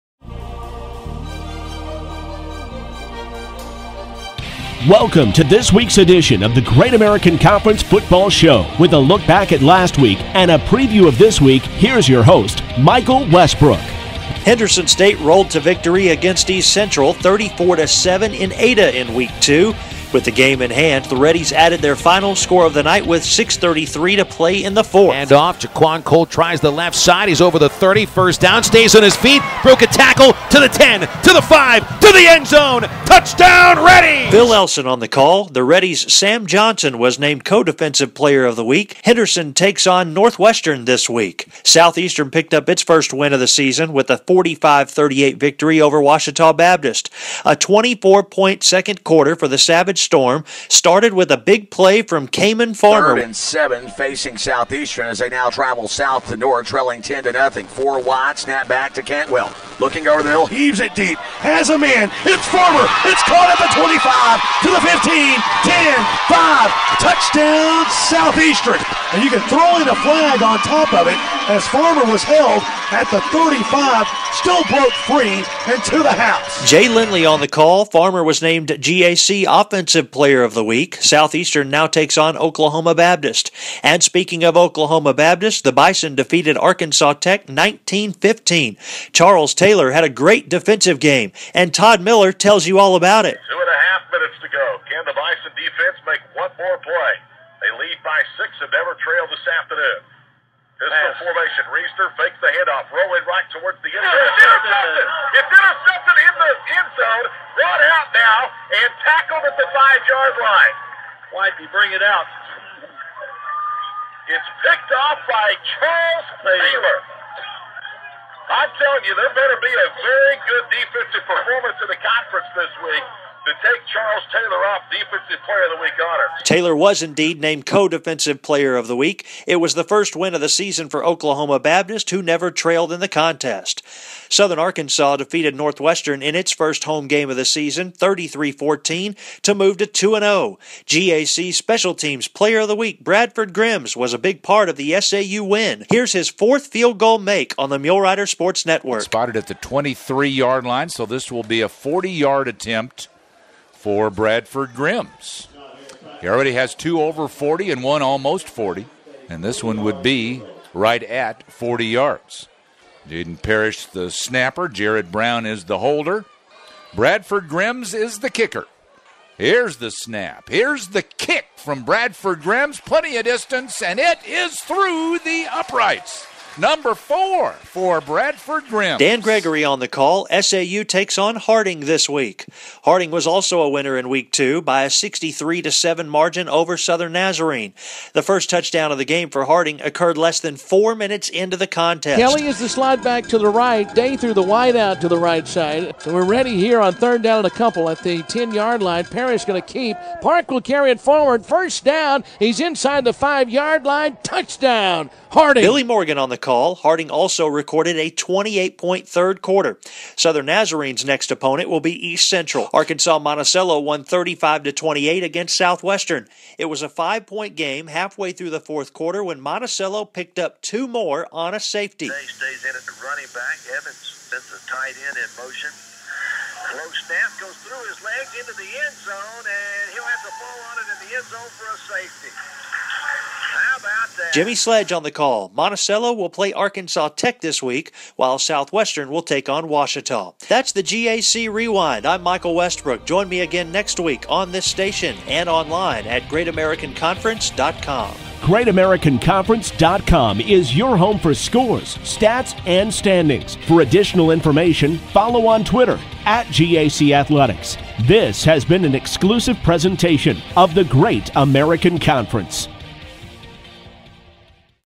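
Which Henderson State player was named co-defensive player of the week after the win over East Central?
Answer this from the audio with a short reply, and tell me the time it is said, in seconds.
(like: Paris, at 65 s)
Sam Johnson, at 36 s.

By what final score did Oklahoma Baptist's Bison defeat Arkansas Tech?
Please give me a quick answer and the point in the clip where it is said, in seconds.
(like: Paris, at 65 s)
19-15, at 87 s.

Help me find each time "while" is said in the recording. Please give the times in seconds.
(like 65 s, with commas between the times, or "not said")
238 s.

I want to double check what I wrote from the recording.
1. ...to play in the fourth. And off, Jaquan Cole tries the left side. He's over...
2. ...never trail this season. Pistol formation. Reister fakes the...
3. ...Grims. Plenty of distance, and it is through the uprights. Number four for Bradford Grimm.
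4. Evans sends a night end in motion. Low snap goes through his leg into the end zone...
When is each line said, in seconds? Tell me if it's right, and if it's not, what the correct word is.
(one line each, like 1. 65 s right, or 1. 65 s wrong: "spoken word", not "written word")
1. 24 s right
2. 98 s wrong: "afternoon", not "season"
3. 172 s right
4. 223 s wrong: "tight", not "night".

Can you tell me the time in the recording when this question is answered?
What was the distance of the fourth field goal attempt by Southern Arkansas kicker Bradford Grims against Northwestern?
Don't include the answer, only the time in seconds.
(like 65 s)
151 s.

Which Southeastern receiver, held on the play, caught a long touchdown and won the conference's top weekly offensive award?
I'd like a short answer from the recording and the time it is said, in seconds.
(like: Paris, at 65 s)
Cayman Farmer, at 52 s.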